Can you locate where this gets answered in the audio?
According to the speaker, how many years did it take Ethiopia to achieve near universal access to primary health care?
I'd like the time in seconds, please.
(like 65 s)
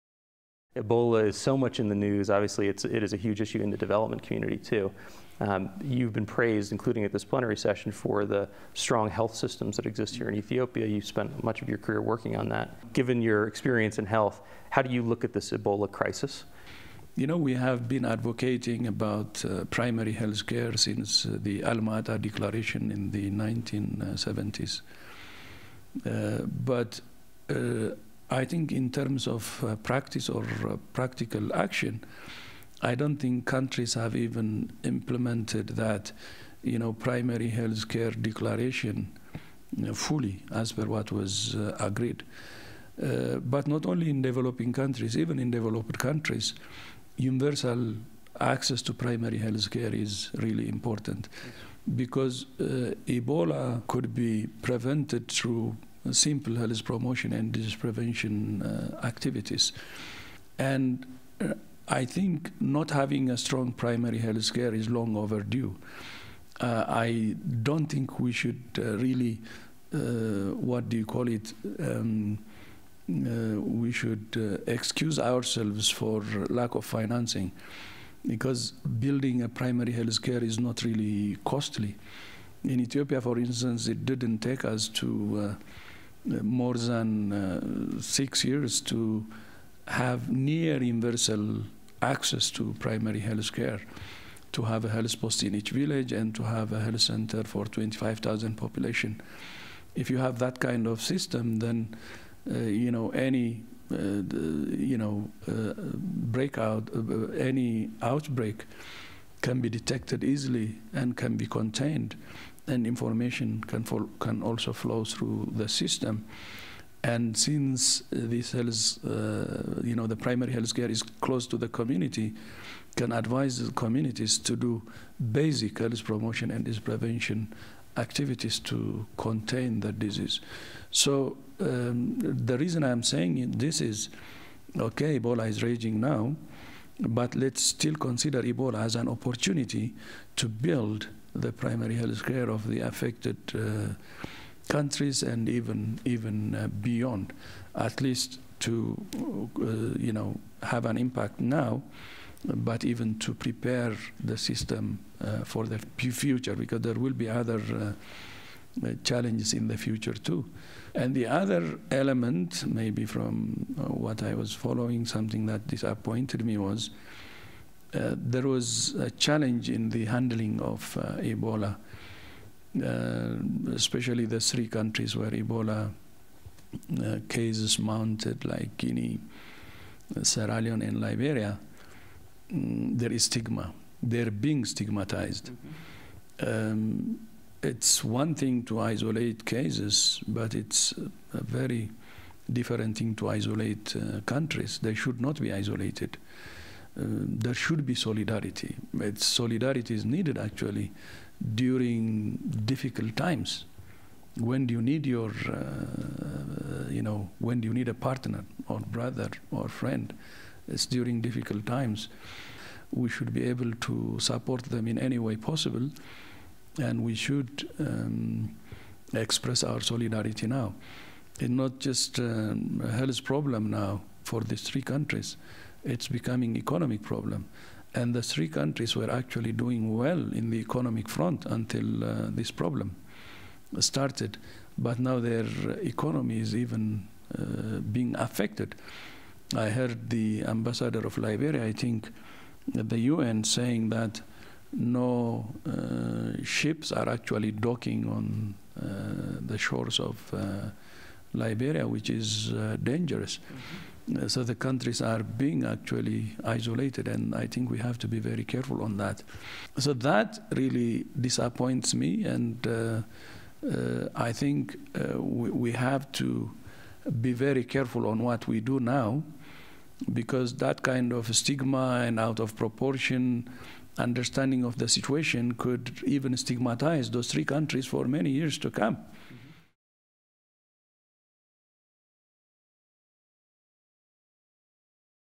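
87 s.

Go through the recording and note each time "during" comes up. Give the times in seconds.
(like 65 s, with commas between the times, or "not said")
201 s, 210 s.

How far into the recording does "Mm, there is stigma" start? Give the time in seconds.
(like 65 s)
182 s.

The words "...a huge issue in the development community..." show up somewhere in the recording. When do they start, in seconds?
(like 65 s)
3 s.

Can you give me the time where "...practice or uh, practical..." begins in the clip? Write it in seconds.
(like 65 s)
29 s.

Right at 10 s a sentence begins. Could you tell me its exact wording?
You spent much of your career working on that.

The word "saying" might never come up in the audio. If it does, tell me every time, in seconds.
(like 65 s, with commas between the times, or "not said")
133 s, 243 s.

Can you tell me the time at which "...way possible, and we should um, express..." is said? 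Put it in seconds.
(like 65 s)
215 s.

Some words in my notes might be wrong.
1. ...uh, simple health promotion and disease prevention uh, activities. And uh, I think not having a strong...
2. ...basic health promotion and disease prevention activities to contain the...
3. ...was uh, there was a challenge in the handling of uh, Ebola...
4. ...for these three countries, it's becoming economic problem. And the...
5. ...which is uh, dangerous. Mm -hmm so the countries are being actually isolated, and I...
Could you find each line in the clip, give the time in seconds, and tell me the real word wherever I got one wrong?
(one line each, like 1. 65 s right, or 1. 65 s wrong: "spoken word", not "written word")
1. 56 s right
2. 125 s right
3. 166 s right
4. 224 s right
5. 251 s right.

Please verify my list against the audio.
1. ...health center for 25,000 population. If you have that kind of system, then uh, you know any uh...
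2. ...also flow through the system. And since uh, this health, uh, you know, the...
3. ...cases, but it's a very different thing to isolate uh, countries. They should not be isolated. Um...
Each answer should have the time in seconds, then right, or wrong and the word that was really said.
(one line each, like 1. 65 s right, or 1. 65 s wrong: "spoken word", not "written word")
1. 96 s right
2. 114 s right
3. 189 s right.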